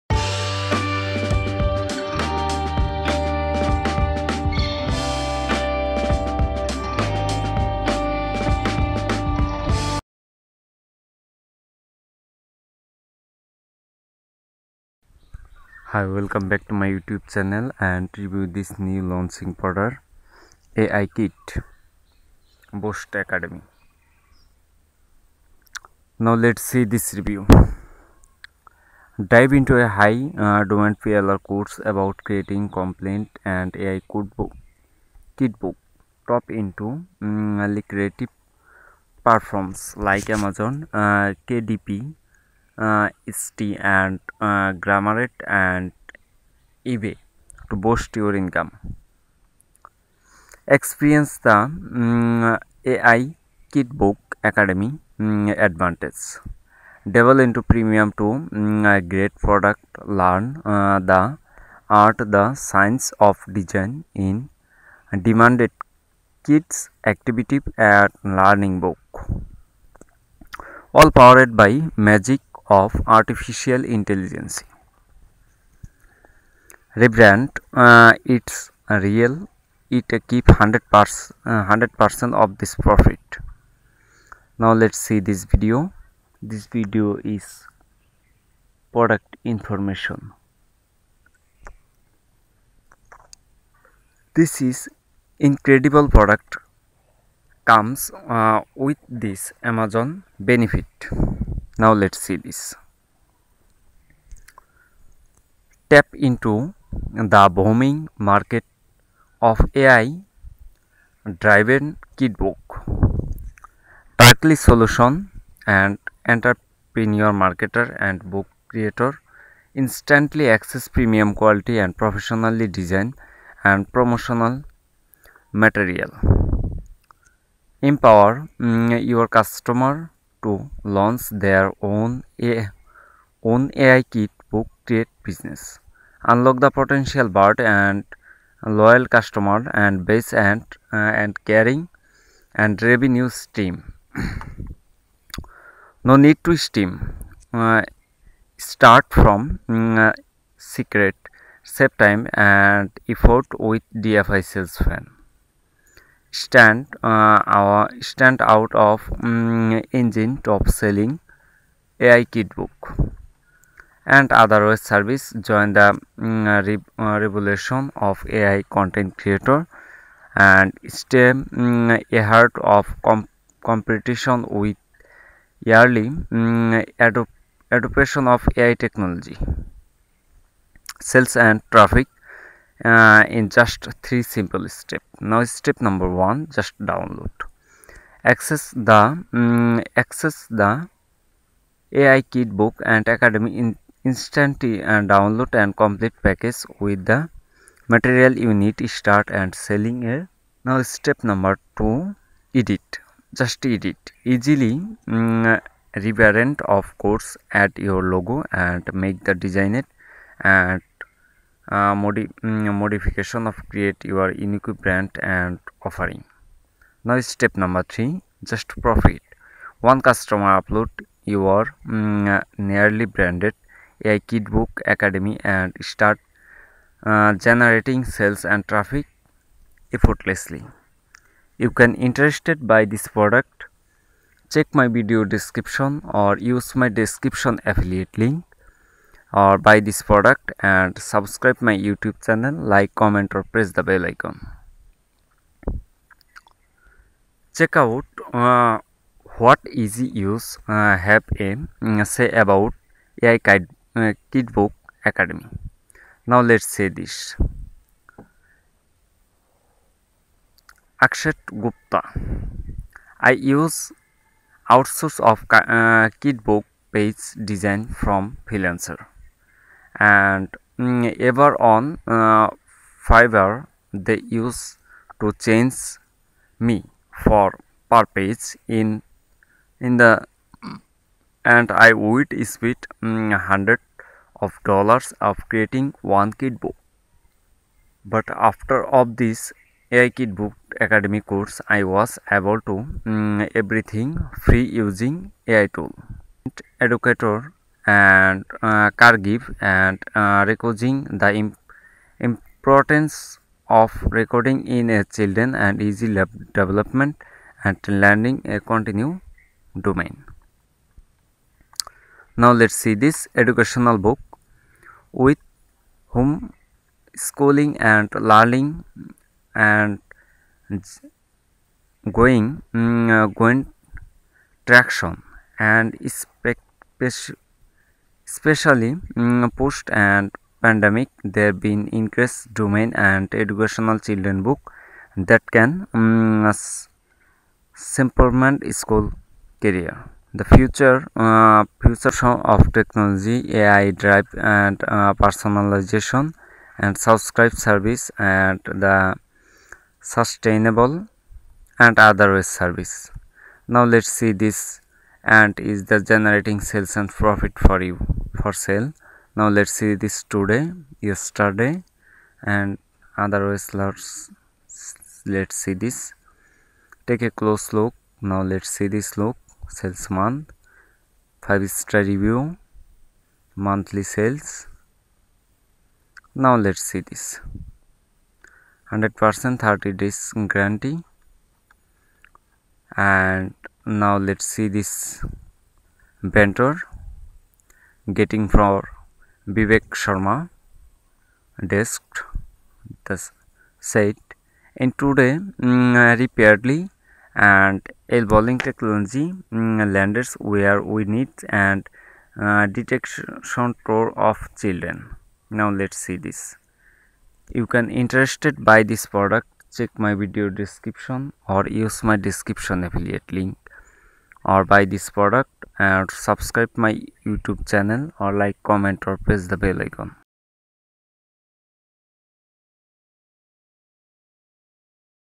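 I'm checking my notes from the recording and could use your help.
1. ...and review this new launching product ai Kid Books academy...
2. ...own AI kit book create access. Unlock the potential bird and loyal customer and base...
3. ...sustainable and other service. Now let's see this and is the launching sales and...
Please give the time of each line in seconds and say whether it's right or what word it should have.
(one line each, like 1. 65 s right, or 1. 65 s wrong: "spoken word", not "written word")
1. 17 s right
2. 133 s wrong: "business", not "access"
3. 349 s wrong: "generating", not "launching".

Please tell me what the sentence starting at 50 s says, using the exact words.
Experience the um, mm, AI Kitbook Academy um, advantage.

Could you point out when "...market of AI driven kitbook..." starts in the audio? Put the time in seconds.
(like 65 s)
108 s.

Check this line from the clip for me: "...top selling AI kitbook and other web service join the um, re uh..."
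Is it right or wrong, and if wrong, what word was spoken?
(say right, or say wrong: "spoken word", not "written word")
right.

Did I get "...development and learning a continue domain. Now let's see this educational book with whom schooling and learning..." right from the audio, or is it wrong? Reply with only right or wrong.
right.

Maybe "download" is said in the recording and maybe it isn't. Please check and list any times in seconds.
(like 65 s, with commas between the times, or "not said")
186 s, 195 s.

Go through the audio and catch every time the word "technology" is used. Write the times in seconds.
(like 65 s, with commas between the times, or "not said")
178 s, 342 s, 398 s.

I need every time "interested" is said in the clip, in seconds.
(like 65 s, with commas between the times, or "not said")
231 s, 407 s.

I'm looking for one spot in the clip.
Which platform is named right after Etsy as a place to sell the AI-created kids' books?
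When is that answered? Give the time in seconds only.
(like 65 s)
44 s.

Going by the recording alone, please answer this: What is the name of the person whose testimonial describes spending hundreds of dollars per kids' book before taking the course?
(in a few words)
Akshat Gupta.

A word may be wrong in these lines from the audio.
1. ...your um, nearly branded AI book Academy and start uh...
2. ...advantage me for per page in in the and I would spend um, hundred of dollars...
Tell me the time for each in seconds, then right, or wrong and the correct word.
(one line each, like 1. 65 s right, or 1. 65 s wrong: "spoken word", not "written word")
1. 221 s right
2. 275 s wrong: "change", not "advantage".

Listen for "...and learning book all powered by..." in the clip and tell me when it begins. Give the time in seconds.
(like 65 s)
67 s.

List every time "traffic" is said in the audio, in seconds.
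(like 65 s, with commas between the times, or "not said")
181 s, 228 s.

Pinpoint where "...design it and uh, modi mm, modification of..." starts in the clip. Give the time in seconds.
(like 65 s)
209 s.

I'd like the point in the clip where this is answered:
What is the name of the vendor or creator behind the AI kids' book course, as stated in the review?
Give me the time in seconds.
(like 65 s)
389 s.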